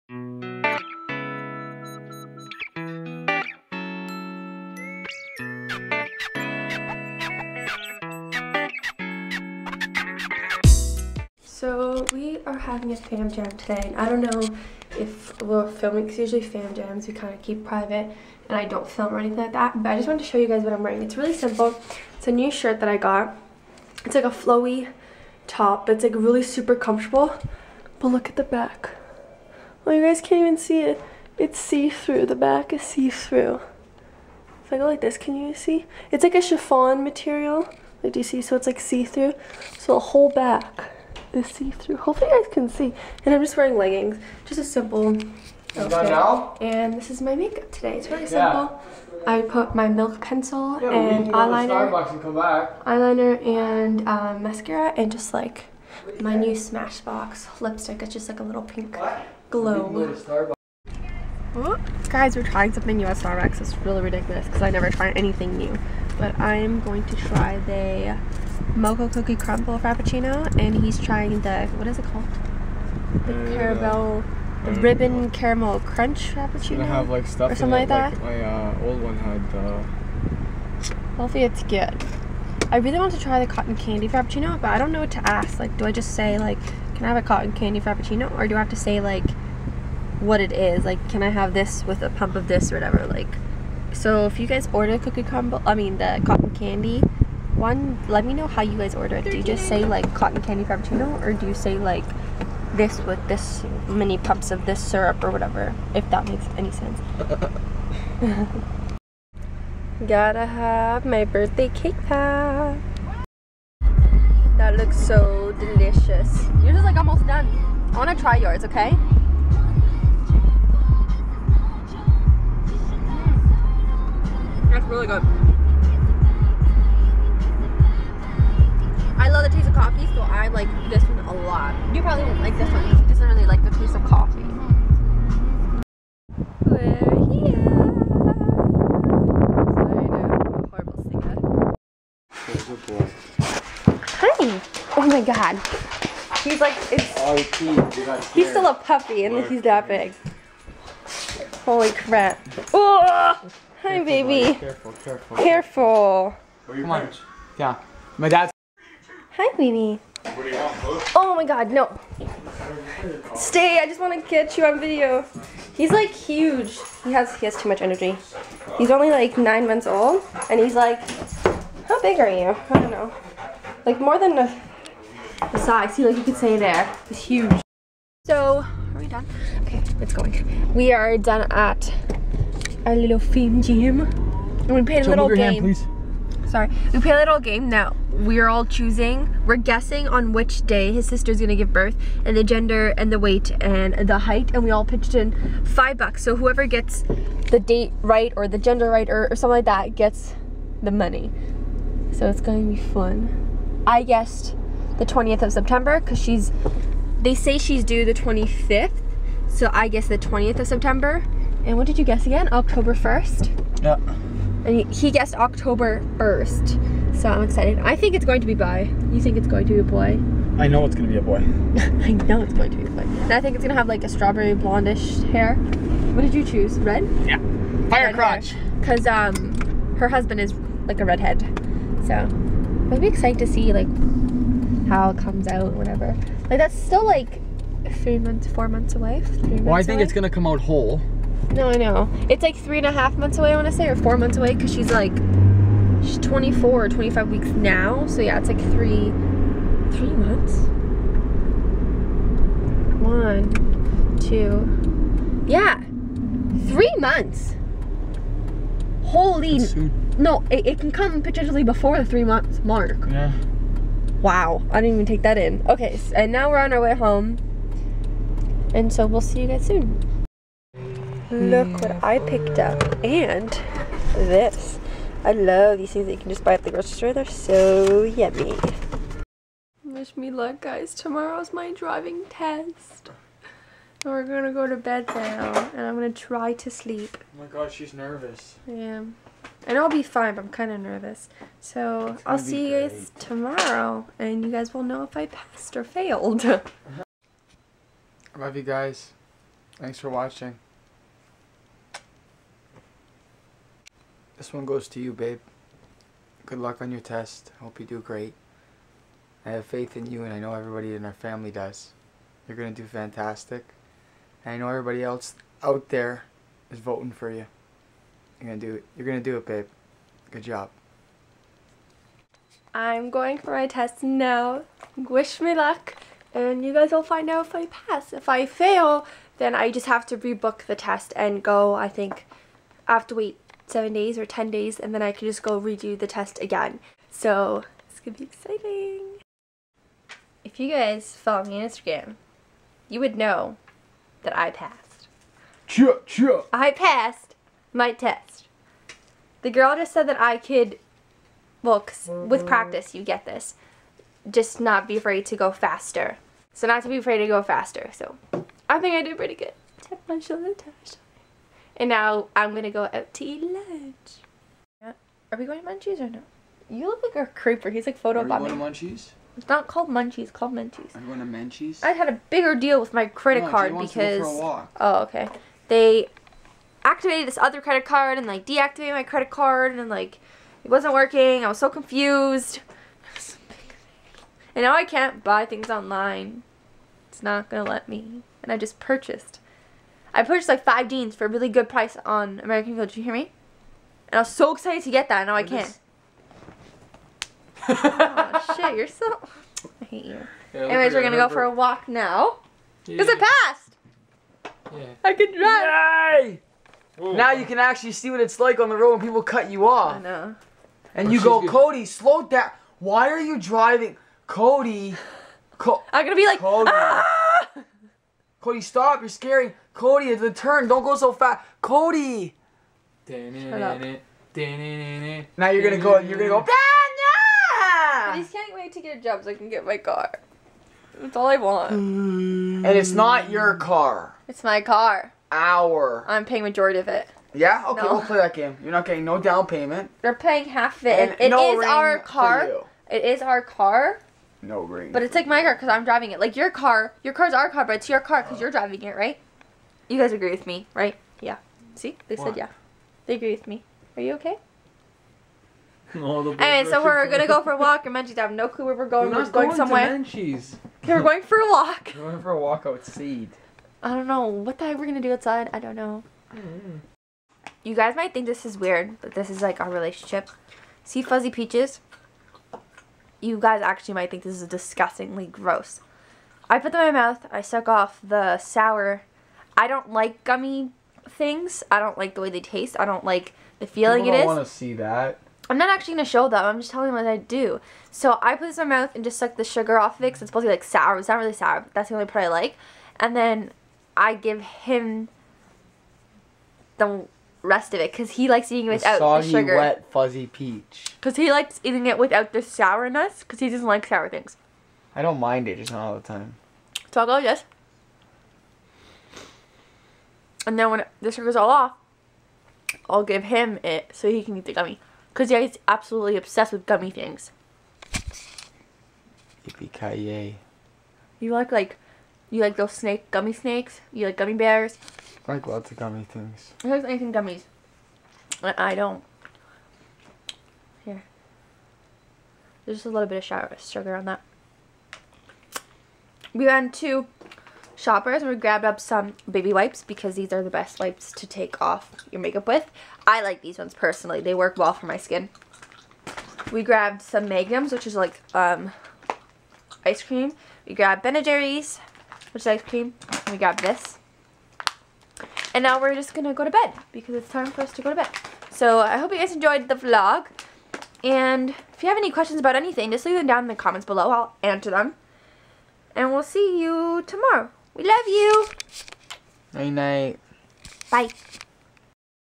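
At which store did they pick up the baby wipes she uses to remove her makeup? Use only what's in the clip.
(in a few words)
Shoppers.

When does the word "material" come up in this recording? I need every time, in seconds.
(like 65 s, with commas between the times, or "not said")
37 s.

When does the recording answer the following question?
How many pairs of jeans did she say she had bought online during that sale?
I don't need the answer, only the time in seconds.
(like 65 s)
390 s.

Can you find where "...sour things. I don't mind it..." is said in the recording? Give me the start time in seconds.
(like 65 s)
503 s.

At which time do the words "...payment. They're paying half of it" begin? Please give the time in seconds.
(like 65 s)
439 s.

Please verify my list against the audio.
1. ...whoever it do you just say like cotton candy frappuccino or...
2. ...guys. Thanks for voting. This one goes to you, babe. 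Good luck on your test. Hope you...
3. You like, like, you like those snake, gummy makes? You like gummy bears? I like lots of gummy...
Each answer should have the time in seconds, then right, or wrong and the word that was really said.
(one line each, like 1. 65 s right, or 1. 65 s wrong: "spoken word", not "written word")
1. 98 s wrong: "order", not "whoever"
2. 298 s wrong: "watching", not "voting"
3. 521 s wrong: "snakes", not "makes".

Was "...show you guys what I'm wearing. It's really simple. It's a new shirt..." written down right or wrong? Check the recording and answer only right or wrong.
right.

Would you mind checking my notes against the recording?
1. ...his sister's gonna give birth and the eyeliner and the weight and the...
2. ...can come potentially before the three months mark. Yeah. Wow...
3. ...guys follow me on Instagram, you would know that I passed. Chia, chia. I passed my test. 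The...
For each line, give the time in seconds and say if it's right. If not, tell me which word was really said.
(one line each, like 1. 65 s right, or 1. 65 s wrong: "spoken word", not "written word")
1. 190 s wrong: "gender", not "eyeliner"
2. 260 s right
3. 340 s right.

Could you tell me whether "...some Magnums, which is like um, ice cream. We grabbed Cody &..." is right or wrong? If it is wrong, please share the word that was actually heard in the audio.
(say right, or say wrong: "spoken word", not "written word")
wrong: "Ben", not "Cody".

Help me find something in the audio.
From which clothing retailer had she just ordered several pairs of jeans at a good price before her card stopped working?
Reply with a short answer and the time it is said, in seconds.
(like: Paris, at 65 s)
American Eagle, at 392 s.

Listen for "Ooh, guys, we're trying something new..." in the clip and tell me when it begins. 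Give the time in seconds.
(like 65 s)
61 s.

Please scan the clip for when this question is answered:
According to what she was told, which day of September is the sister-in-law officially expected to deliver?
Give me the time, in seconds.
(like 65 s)
208 s.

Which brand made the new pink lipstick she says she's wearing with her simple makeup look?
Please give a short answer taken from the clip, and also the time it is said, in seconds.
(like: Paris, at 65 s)
Smashbox, at 56 s.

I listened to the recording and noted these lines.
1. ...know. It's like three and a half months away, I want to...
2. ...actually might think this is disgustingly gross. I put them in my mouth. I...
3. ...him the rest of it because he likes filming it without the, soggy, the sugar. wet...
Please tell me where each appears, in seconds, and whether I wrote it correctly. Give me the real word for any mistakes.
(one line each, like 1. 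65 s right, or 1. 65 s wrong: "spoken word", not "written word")
1. 241 s right
2. 473 s right
3. 494 s wrong: "eating", not "filming".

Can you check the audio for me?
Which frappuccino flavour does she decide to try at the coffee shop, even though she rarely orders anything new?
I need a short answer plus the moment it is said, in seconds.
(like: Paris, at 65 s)
Mocha cookie crumble, at 68 s.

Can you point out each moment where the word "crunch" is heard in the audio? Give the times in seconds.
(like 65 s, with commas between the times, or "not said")
75 s.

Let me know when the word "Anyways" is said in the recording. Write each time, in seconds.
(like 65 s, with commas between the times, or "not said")
400 s.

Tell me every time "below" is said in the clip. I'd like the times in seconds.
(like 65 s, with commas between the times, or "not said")
563 s.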